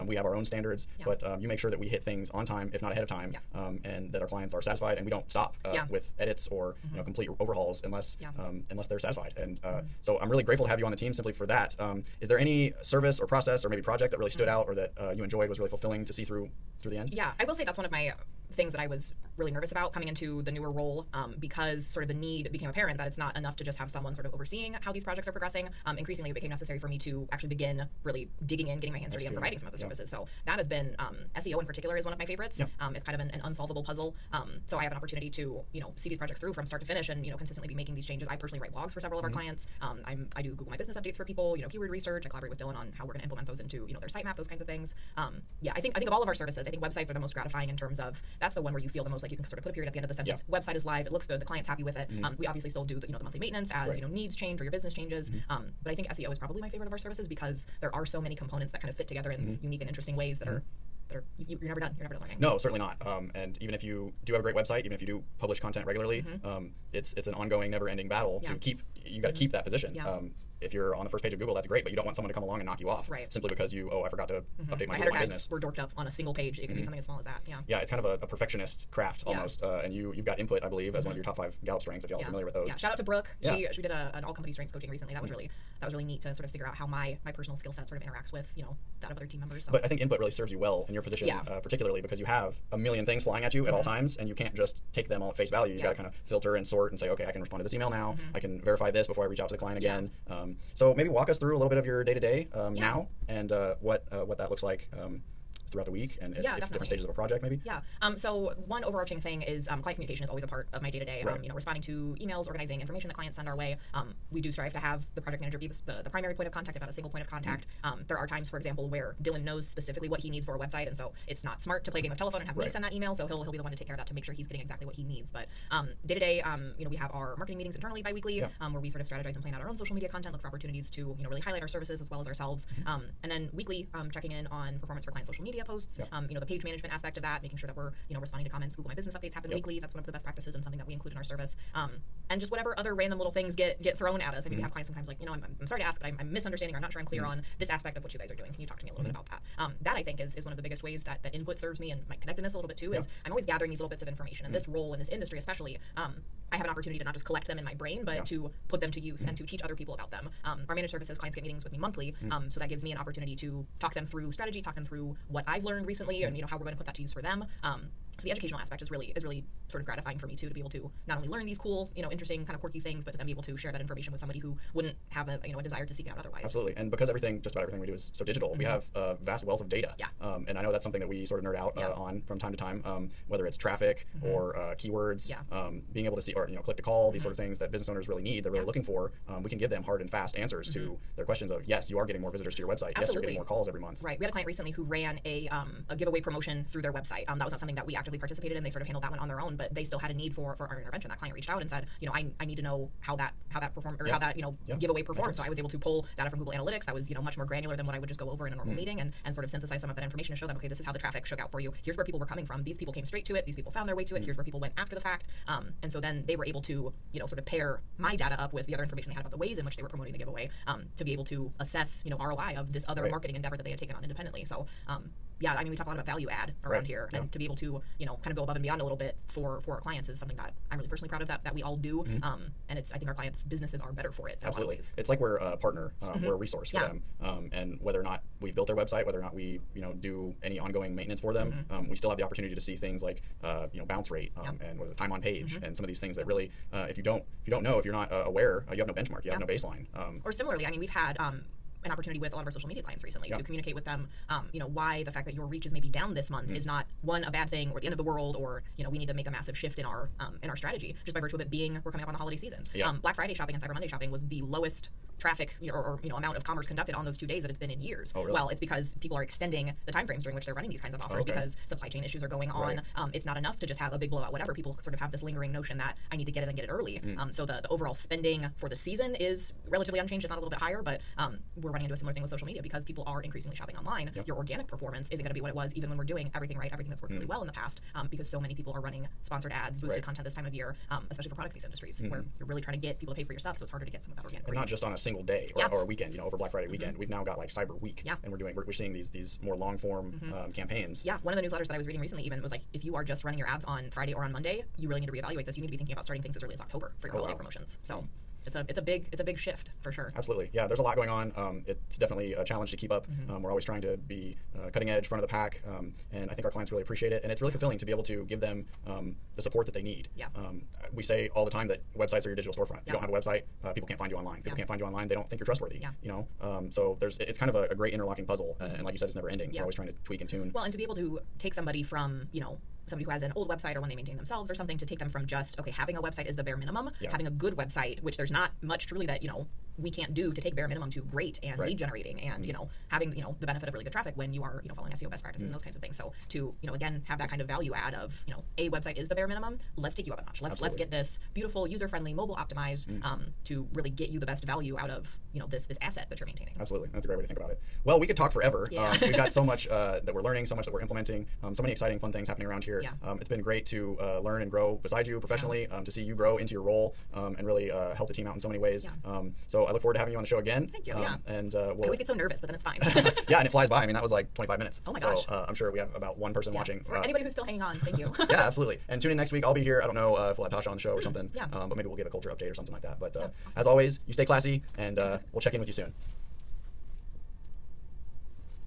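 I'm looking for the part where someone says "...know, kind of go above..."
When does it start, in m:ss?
3:48.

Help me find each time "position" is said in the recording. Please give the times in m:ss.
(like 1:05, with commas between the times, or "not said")
1:09, 1:31.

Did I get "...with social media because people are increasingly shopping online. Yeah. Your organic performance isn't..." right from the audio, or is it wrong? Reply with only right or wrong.
right.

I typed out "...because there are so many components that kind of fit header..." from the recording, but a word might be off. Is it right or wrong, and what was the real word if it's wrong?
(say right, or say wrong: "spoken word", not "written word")
wrong: "together", not "header".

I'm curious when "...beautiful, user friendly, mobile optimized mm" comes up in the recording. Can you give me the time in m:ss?
5:51.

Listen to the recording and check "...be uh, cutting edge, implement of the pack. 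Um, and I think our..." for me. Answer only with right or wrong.
wrong.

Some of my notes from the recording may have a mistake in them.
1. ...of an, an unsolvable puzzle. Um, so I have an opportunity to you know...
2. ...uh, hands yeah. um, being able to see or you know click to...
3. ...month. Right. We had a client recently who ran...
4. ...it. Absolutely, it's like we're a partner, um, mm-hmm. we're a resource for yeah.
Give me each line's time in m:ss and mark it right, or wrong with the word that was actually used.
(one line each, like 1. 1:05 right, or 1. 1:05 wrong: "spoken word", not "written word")
1. 0:33 right
2. 3:04 wrong: "keywords", not "hands"
3. 3:13 right
4. 3:54 right.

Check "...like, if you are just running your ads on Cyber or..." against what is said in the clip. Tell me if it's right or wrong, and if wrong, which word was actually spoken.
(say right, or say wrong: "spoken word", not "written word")
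wrong: "Friday", not "Cyber".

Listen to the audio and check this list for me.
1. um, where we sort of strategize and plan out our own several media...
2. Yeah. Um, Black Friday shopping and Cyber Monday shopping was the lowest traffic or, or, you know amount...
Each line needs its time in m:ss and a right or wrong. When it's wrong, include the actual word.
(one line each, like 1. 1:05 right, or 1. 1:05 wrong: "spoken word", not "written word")
1. 2:08 wrong: "social", not "several"
2. 4:22 right.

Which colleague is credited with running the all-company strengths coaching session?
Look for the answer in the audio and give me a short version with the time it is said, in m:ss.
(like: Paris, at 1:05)
Brooke, at 1:23.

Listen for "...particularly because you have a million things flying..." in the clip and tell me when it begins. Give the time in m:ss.
1:31.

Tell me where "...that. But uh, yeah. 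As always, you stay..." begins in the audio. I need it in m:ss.
6:22.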